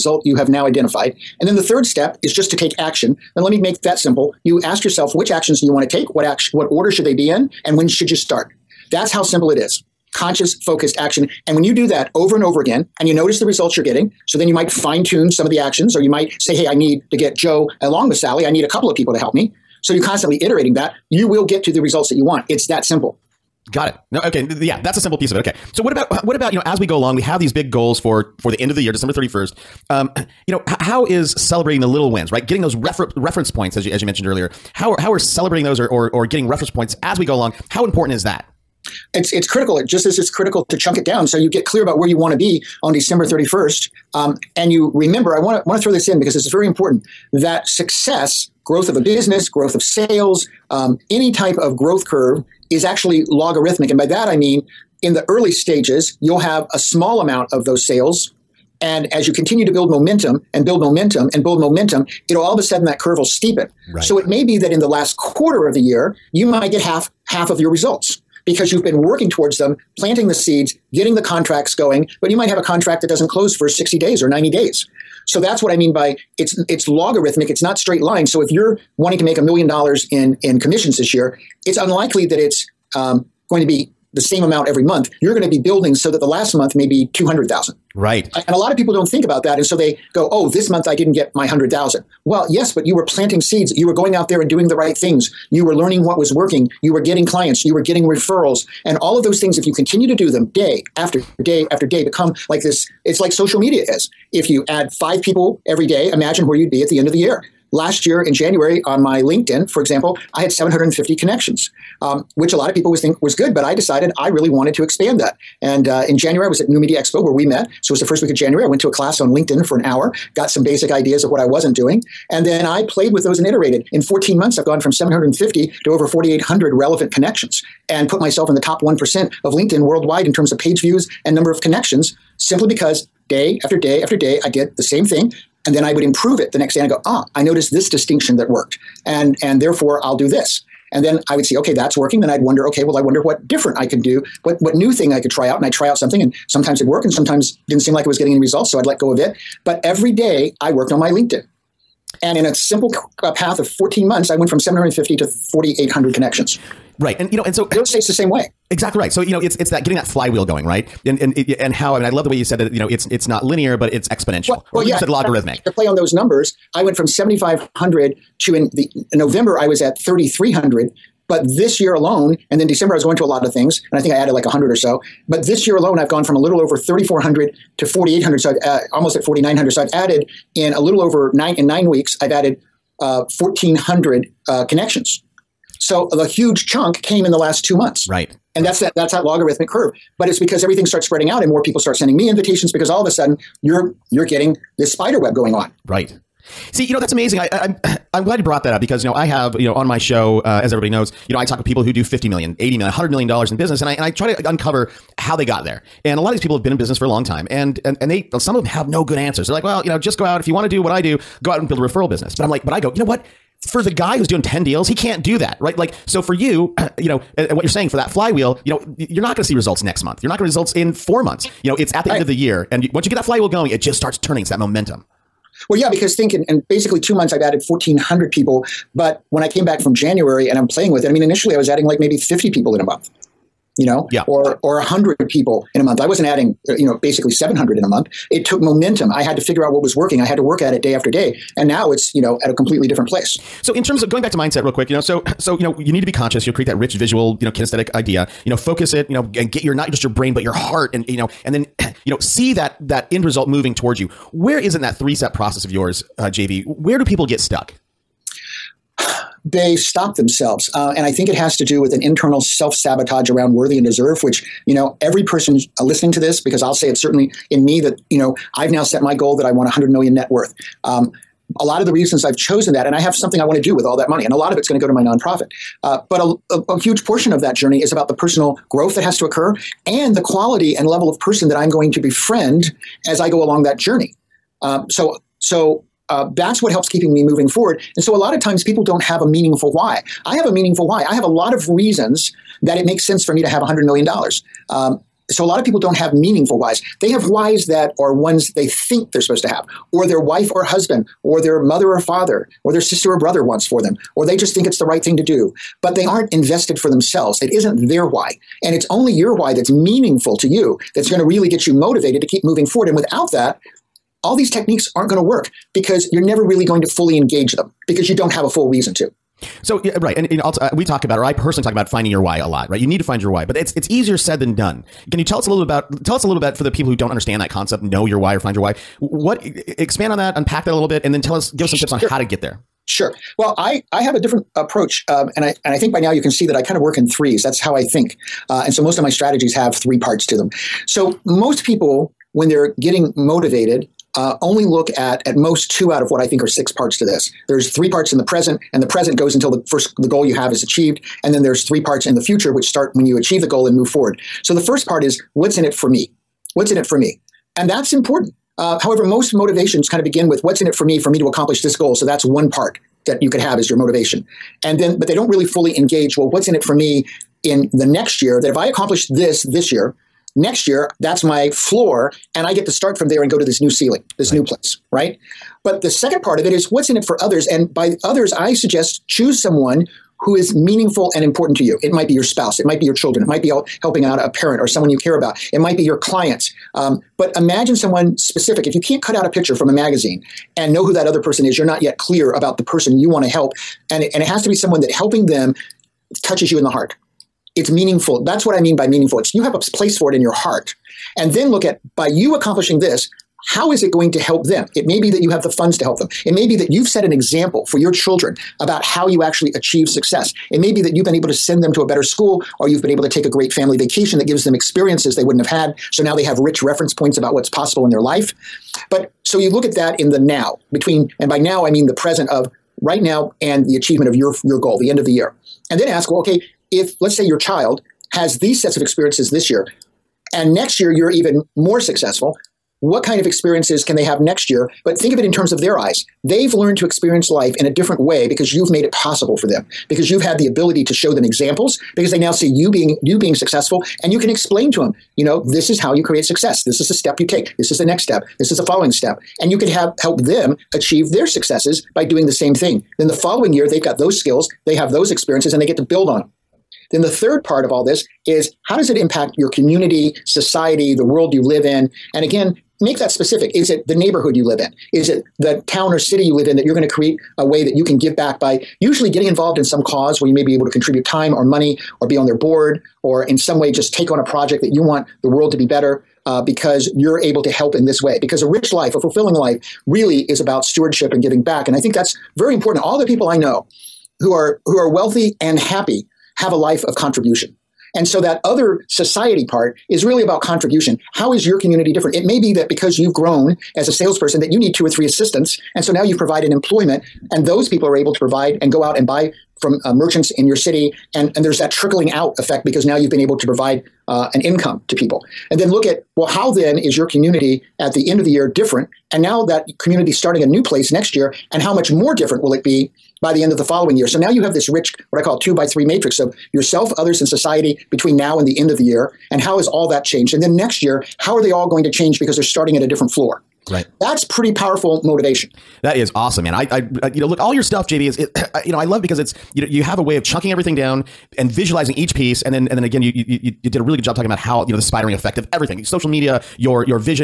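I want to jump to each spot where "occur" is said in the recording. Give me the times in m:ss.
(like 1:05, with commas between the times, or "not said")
4:39.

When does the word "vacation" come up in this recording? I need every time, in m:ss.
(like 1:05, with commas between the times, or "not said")
6:53.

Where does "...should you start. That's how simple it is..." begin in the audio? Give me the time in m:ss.
0:07.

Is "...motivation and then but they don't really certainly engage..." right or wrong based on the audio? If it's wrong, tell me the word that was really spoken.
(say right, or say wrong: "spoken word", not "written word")
wrong: "fully", not "certainly".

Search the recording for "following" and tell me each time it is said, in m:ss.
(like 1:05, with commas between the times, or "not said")
7:28, 7:33, 8:33.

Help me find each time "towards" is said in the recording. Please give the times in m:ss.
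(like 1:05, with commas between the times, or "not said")
1:09, 4:13.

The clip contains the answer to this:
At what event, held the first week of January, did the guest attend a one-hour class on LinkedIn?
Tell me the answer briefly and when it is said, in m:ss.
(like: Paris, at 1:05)
New Media Expo, at 1:56.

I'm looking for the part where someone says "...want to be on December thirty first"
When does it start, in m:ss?
0:42.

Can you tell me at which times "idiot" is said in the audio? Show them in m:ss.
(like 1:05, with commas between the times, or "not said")
not said.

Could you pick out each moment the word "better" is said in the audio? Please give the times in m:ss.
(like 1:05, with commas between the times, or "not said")
6:51, 7:55.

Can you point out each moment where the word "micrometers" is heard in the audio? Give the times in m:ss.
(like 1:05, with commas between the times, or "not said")
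not said.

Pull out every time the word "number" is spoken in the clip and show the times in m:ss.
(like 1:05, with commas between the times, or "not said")
2:11, 2:46.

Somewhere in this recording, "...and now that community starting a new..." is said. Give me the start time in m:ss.
8:29.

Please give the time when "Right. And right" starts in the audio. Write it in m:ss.
3:08.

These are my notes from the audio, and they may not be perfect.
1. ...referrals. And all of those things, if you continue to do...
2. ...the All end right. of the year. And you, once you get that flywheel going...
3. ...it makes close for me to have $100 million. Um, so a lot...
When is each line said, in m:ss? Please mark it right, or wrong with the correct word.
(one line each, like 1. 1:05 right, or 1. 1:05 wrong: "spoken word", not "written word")
1. 1:38 right
2. 3:42 right
3. 4:52 wrong: "sense", not "close".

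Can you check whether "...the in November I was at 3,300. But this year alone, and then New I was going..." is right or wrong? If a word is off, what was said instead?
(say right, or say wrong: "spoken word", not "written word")
wrong: "December", not "New".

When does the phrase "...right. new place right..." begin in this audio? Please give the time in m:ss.
6:14.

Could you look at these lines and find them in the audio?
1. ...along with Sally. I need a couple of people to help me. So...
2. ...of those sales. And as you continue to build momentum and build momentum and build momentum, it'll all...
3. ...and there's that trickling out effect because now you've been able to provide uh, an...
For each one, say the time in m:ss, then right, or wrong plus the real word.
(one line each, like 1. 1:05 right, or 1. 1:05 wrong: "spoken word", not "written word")
1. 0:17 right
2. 0:57 right
3. 8:21 right.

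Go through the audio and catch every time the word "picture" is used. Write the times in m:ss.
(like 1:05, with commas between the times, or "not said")
6:29.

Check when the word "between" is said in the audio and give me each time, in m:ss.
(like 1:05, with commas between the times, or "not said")
7:00, 8:37.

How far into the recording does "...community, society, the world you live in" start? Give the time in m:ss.
7:39.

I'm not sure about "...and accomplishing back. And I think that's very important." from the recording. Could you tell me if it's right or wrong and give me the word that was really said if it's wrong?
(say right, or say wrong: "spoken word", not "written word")
wrong: "giving", not "accomplishing".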